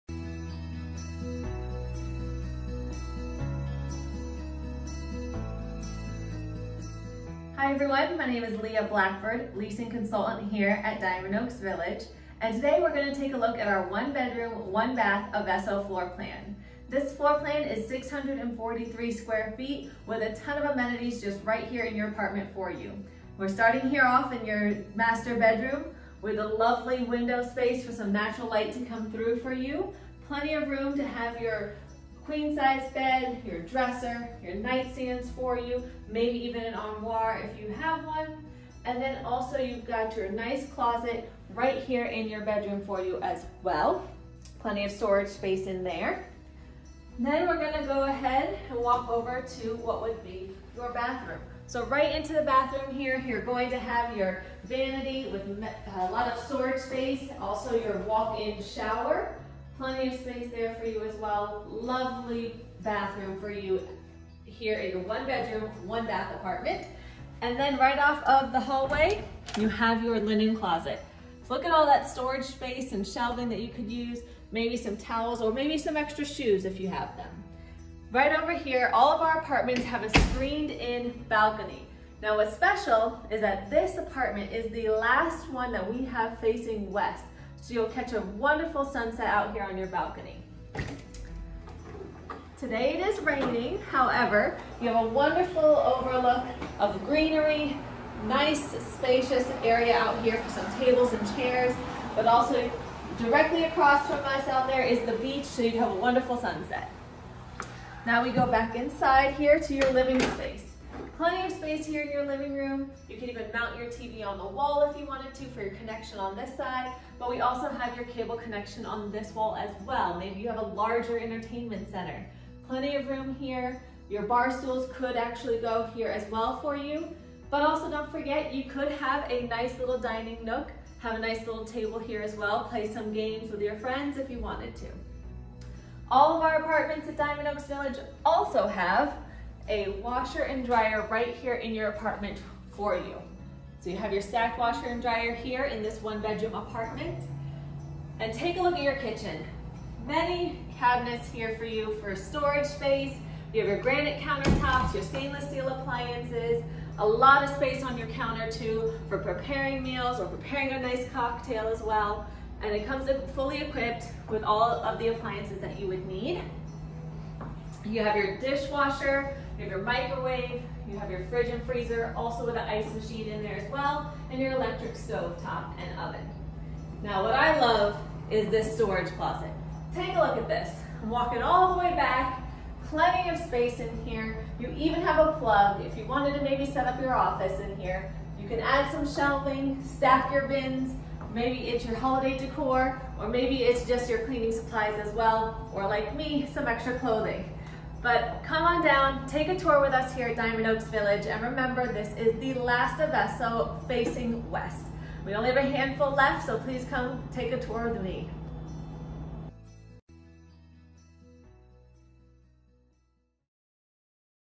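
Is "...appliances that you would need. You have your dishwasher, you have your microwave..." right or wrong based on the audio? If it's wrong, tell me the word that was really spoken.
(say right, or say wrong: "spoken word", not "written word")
right.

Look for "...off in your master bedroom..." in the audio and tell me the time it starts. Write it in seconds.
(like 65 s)
24 s.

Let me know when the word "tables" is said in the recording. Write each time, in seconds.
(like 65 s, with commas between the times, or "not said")
100 s, 131 s.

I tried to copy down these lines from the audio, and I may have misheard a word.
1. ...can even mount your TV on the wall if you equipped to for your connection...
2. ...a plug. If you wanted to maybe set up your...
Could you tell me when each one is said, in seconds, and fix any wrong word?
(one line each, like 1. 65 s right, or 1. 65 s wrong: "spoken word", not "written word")
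1. 113 s wrong: "wanted", not "equipped"
2. 185 s right.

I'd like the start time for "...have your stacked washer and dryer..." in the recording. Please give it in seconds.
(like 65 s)
143 s.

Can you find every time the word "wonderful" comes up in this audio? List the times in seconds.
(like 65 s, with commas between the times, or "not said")
88 s, 95 s, 105 s.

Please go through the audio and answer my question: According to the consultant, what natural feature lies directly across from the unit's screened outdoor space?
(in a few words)
The beach.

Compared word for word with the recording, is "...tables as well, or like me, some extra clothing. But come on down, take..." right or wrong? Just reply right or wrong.
wrong.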